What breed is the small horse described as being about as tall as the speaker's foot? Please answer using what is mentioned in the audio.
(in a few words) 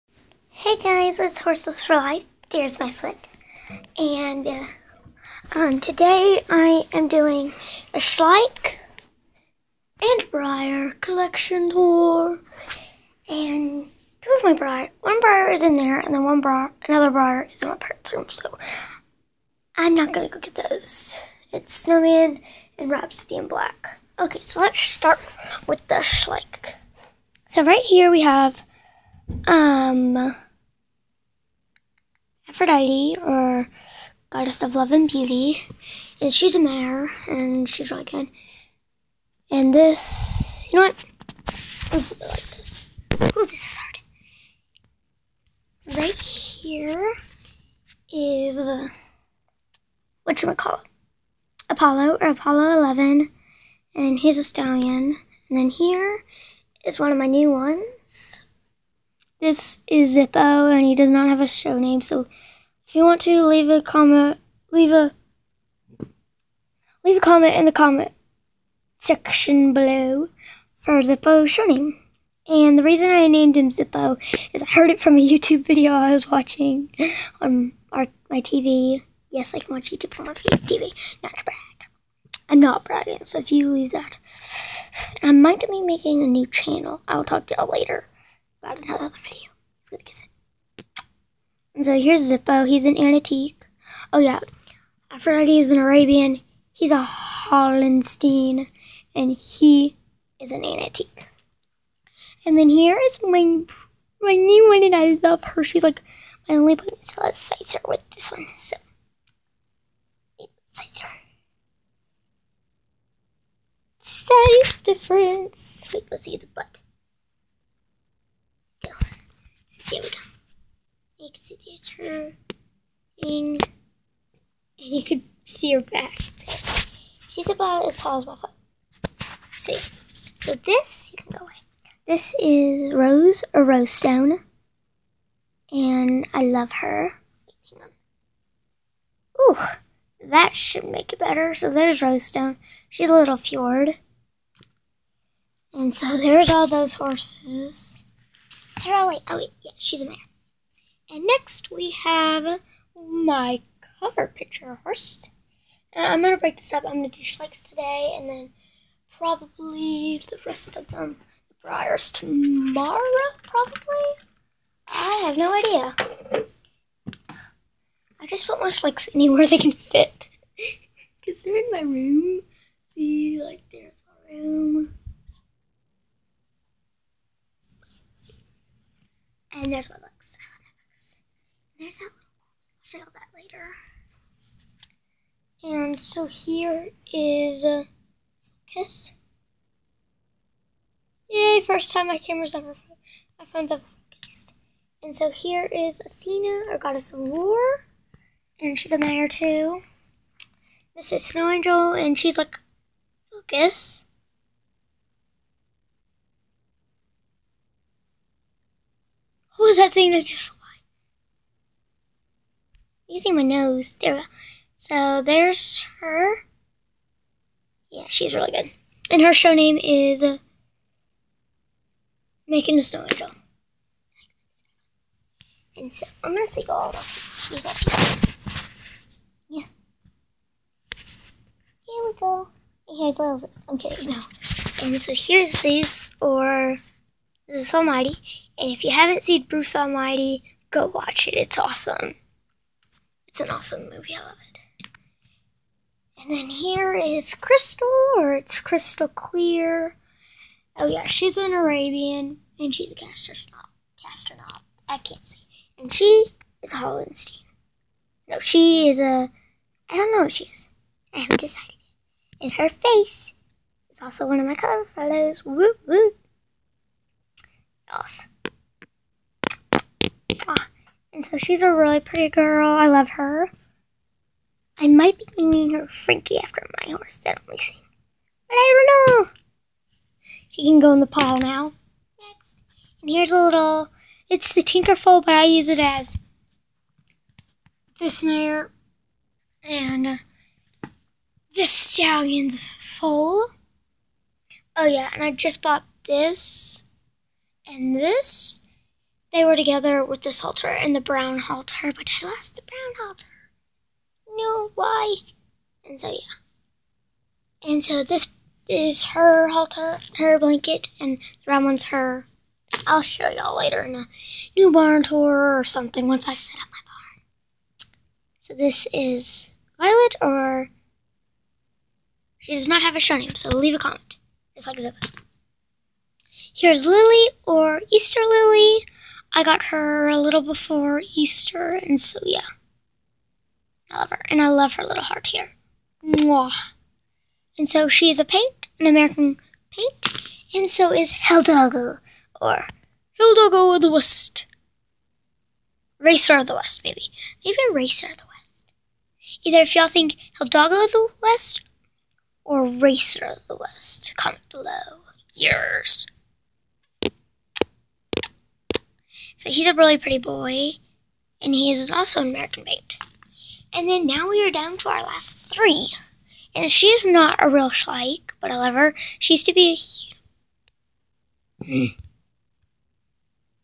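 Fjord.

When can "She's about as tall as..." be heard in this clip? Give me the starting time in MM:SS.
02:07.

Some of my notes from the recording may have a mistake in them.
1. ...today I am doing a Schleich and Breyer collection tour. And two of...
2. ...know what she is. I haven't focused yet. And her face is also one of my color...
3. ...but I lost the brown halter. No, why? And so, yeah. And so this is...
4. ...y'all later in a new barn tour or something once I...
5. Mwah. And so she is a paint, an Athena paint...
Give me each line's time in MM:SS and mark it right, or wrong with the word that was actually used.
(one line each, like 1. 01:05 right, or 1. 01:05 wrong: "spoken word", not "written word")
1. 00:05 right
2. 04:20 wrong: "decided", not "focused"
3. 05:01 right
4. 05:13 right
5. 05:36 wrong: "American", not "Athena".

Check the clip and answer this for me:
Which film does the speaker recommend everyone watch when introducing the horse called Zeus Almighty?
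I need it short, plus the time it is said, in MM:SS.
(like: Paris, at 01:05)
Bruce Almighty, at 03:59.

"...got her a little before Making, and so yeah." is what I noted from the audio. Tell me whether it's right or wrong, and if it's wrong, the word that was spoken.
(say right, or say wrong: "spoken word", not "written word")
wrong: "Easter", not "Making".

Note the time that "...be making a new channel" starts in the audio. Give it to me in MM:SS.
01:25.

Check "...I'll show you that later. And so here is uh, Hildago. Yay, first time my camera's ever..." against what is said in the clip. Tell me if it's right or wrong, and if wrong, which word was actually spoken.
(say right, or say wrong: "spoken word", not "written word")
wrong: "Kiss", not "Hildago".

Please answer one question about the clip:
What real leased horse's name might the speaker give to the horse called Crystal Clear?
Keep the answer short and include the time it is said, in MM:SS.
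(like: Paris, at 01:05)
Frankie, at 04:35.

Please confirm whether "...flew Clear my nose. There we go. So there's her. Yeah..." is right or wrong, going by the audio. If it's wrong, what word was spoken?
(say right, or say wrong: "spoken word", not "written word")
wrong: "Using", not "Clear".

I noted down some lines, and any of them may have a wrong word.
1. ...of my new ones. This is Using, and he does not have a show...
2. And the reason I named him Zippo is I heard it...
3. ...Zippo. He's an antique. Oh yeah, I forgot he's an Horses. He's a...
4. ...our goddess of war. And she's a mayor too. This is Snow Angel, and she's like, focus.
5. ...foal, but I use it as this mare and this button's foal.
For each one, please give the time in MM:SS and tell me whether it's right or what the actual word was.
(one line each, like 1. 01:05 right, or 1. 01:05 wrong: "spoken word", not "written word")
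1. 00:57 wrong: "Zippo", not "Using"
2. 01:12 right
3. 01:32 wrong: "Arabian", not "Horses"
4. 03:16 right
5. 04:44 wrong: "stallion", not "button".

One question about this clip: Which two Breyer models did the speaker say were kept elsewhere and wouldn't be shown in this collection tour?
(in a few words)
Snowman and Rhapsody in Black.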